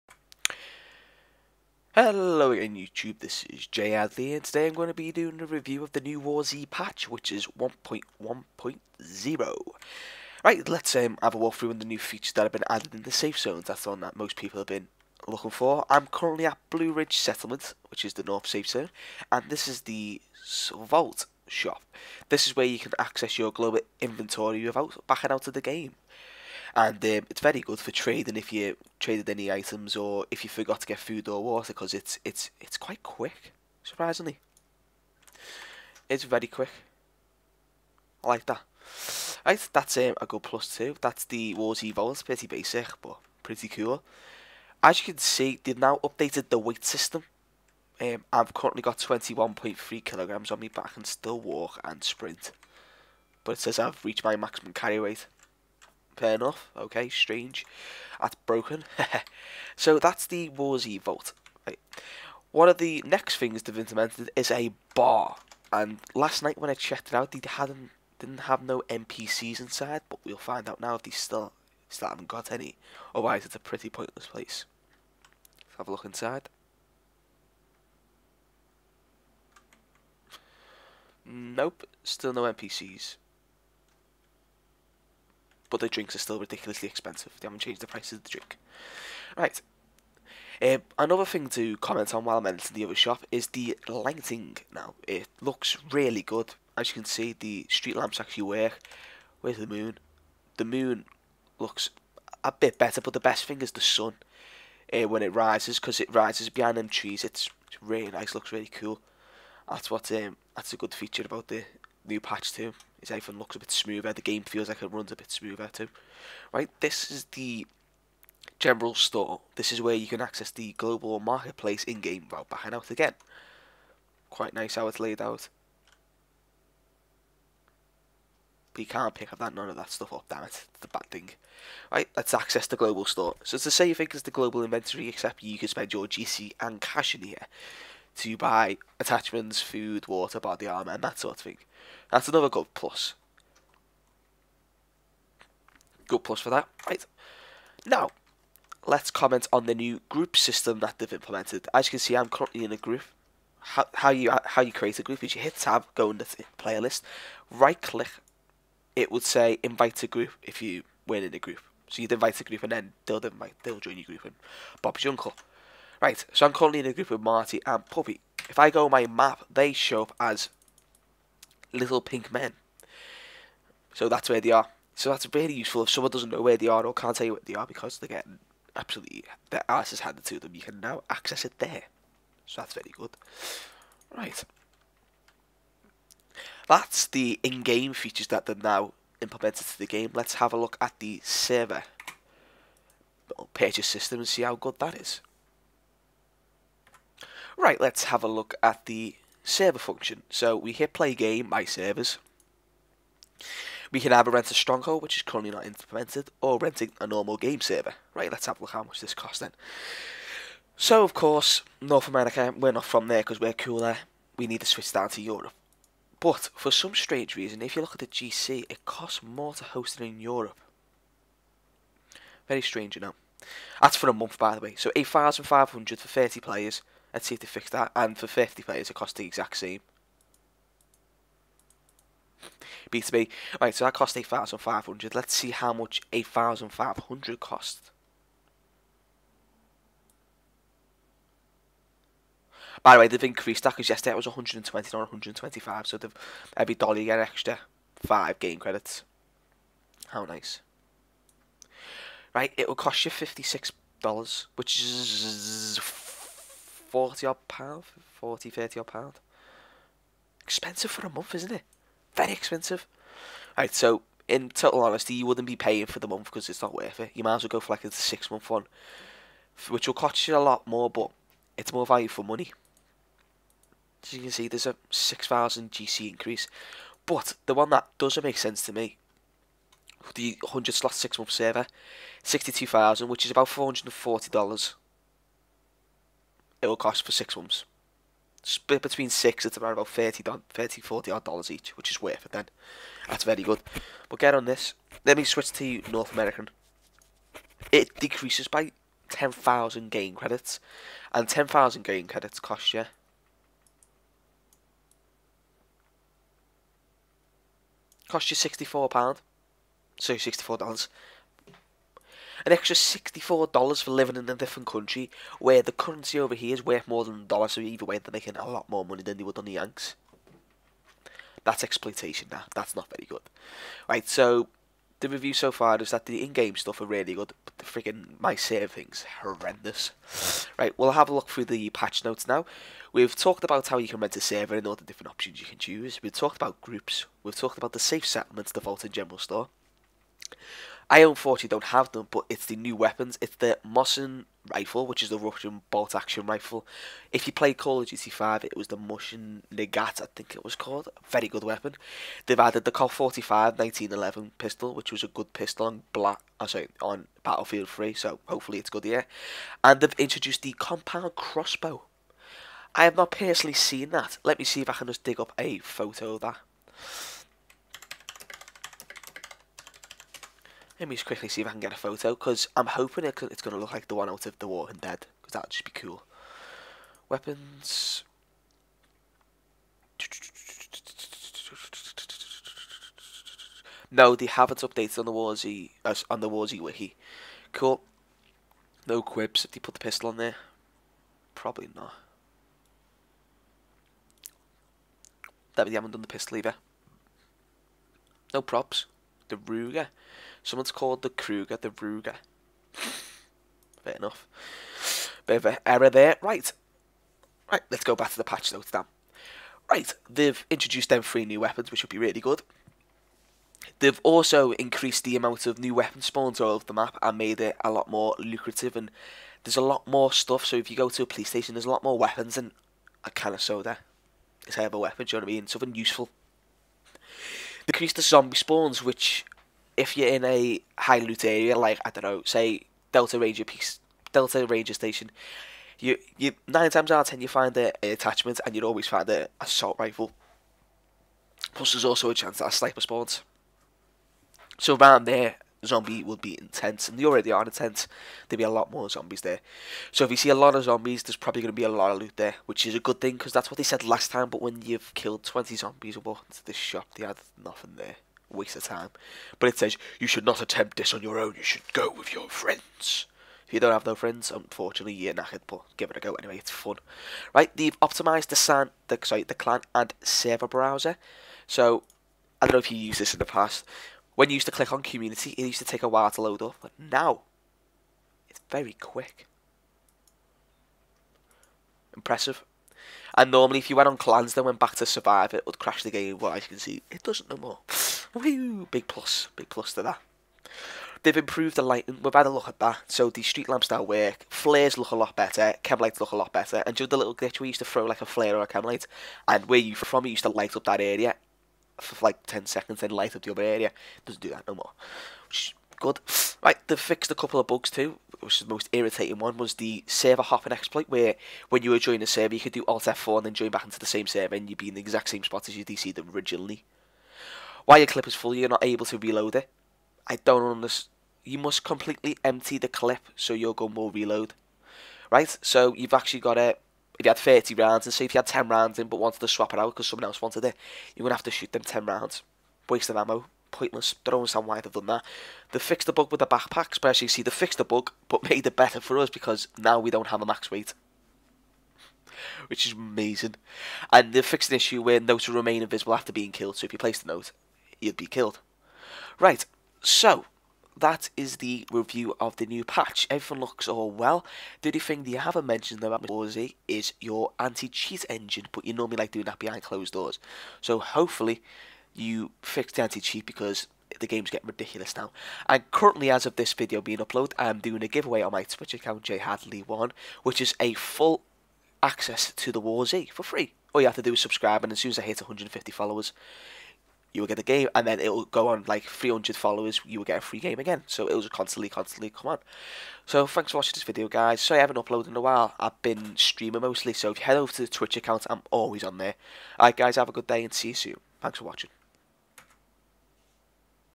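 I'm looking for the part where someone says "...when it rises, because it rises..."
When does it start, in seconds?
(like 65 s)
105 s.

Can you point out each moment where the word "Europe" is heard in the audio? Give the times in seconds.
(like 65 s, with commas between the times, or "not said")
215 s, 220 s.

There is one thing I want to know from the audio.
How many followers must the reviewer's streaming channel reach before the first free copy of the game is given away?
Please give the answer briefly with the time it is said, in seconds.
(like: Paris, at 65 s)
150, at 575 s.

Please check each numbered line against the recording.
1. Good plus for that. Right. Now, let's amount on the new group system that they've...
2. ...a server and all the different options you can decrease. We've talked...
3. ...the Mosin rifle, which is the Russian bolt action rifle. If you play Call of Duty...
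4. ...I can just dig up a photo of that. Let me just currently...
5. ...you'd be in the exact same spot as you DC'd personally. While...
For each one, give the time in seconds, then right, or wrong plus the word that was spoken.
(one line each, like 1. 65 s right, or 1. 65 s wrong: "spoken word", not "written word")
1. 146 s wrong: "comment", not "amount"
2. 334 s wrong: "choose", not "decrease"
3. 343 s right
4. 364 s wrong: "quickly", not "currently"
5. 514 s wrong: "originally", not "personally".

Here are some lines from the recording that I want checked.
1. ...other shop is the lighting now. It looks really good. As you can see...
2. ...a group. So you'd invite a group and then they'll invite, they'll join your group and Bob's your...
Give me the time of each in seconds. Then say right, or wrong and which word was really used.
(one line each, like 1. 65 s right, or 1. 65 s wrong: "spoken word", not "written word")
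1. 92 s right
2. 161 s right.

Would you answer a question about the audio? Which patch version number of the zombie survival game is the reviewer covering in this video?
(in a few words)
1.1.0.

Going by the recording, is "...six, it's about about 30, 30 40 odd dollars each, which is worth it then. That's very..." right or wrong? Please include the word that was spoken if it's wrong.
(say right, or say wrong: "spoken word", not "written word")
right.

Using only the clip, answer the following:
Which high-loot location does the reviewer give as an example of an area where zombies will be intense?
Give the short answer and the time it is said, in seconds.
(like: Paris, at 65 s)
Delta Ranger Station, at 434 s.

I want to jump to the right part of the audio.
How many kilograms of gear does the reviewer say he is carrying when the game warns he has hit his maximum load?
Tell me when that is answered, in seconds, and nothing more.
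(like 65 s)
48 s.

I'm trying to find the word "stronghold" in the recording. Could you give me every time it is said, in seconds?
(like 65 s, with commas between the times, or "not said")
204 s.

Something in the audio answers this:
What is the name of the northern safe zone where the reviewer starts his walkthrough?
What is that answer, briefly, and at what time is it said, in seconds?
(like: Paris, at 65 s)
Blue Ridge Settlement, at 16 s.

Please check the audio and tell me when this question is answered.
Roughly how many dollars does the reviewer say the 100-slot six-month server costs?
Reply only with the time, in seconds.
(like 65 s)
283 s.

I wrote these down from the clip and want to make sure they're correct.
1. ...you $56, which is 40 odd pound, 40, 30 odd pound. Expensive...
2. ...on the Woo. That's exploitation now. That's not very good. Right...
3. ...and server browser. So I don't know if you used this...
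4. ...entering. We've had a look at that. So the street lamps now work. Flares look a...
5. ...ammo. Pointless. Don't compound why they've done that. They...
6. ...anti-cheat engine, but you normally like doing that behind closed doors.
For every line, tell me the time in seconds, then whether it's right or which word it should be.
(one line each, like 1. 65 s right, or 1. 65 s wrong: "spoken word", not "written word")
1. 253 s right
2. 319 s wrong: "Yanks", not "Woo"
3. 469 s right
4. 491 s wrong: "lighting", not "entering"
5. 532 s wrong: "understand", not "compound"
6. 557 s right.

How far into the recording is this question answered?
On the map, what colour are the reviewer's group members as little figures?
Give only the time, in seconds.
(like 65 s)
172 s.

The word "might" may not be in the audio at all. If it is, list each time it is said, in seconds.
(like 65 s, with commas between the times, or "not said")
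267 s.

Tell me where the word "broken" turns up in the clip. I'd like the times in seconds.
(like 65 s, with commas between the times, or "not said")
58 s.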